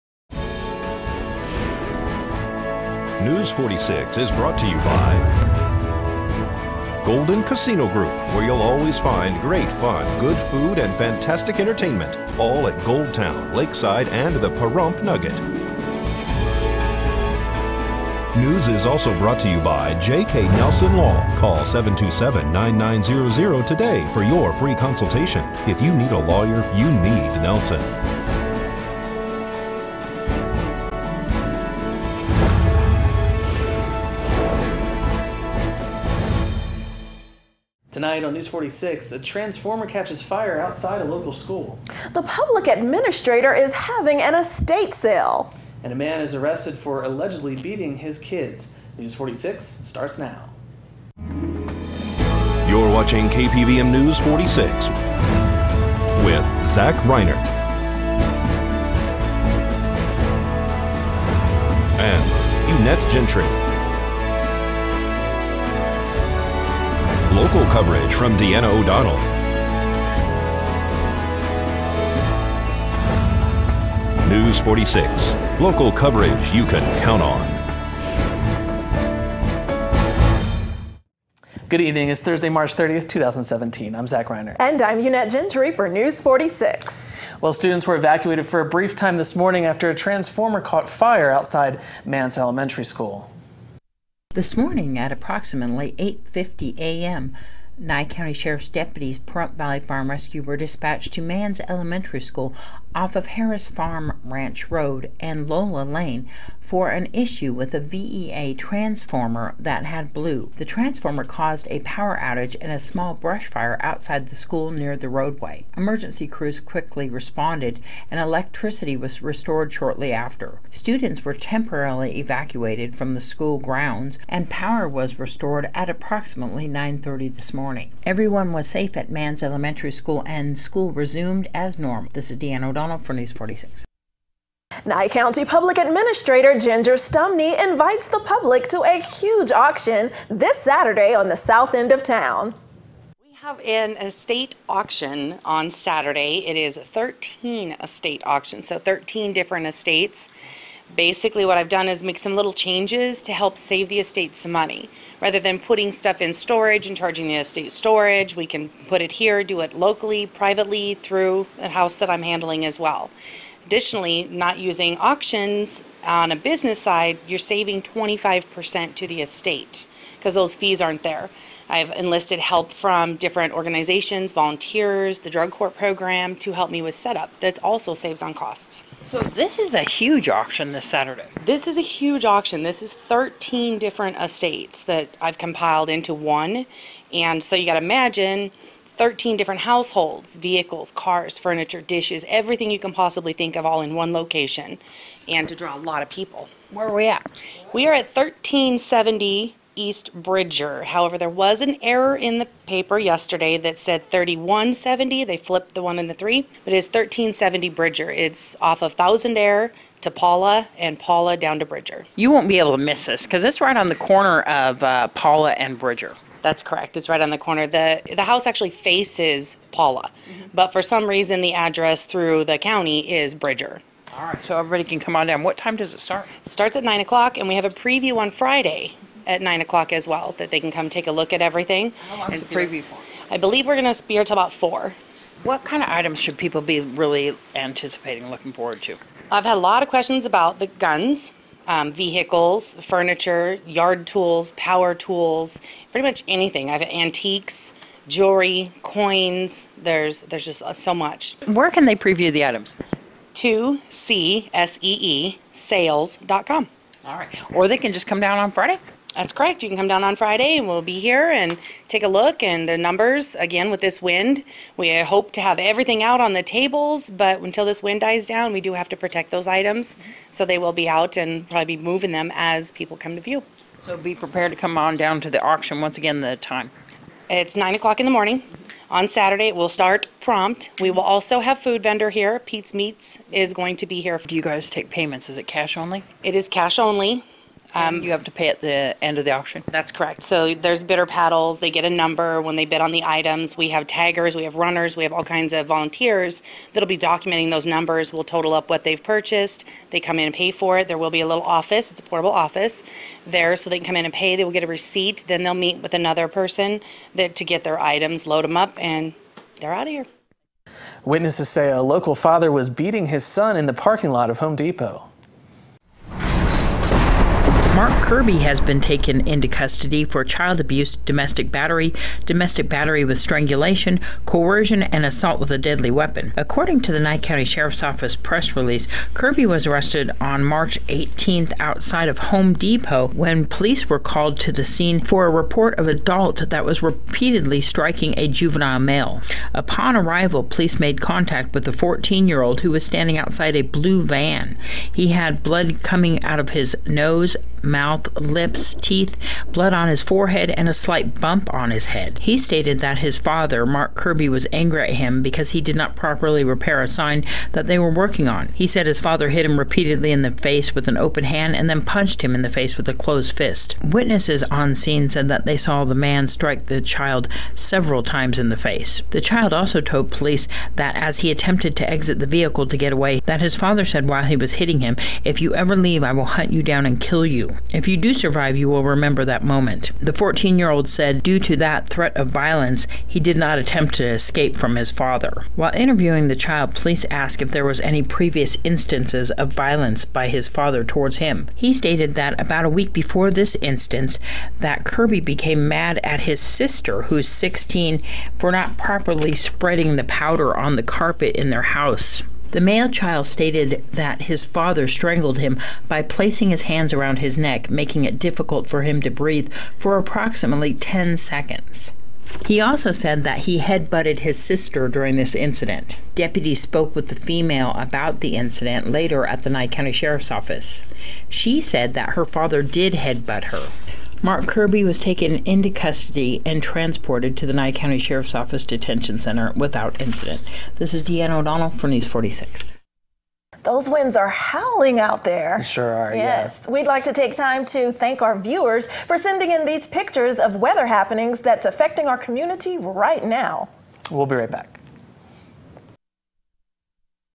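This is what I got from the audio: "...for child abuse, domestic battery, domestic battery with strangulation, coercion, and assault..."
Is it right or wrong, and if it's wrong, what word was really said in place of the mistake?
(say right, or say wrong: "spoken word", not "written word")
right.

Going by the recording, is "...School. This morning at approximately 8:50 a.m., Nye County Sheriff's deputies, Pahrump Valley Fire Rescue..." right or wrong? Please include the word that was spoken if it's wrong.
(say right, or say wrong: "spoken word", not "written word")
right.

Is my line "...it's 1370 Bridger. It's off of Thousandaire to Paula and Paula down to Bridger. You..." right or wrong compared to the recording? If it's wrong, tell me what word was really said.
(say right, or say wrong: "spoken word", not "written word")
right.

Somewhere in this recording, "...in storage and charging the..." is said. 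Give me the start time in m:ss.
2:36.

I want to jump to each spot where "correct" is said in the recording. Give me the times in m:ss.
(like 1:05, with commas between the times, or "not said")
3:36, 4:19, 4:49.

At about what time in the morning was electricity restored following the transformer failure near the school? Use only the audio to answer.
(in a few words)
9:30.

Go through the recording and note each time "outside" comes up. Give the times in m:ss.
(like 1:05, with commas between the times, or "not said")
0:40, 1:31, 1:53, 5:31, 5:43.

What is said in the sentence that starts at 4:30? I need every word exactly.
So they will be out and probably be moving them as people come to view.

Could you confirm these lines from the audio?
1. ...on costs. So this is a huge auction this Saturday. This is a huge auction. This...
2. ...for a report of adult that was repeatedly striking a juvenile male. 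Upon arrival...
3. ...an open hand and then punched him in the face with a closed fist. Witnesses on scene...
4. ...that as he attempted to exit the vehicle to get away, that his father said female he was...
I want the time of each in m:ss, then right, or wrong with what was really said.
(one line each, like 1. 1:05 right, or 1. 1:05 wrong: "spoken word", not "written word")
1. 2:58 right
2. 5:34 right
3. 6:00 right
4. 6:10 wrong: "while", not "female".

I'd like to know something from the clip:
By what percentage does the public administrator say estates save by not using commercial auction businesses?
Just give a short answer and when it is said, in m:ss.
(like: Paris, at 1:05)
25%, at 2:47.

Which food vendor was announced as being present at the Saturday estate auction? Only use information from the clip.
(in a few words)
Pete's Meats.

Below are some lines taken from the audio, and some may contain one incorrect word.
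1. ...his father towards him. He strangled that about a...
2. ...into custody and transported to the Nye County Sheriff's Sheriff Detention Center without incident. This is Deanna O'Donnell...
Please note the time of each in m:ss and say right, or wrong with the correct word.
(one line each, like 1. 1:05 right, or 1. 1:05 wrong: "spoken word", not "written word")
1. 6:30 wrong: "stated", not "strangled"
2. 7:05 wrong: "Office", not "Sheriff".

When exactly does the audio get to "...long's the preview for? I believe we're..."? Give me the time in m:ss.
3:52.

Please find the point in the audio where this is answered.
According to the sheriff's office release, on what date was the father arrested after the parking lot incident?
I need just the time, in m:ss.
5:30.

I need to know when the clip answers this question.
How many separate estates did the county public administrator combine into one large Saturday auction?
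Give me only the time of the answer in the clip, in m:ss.
2:26.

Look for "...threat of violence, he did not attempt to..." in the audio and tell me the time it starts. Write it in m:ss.
6:21.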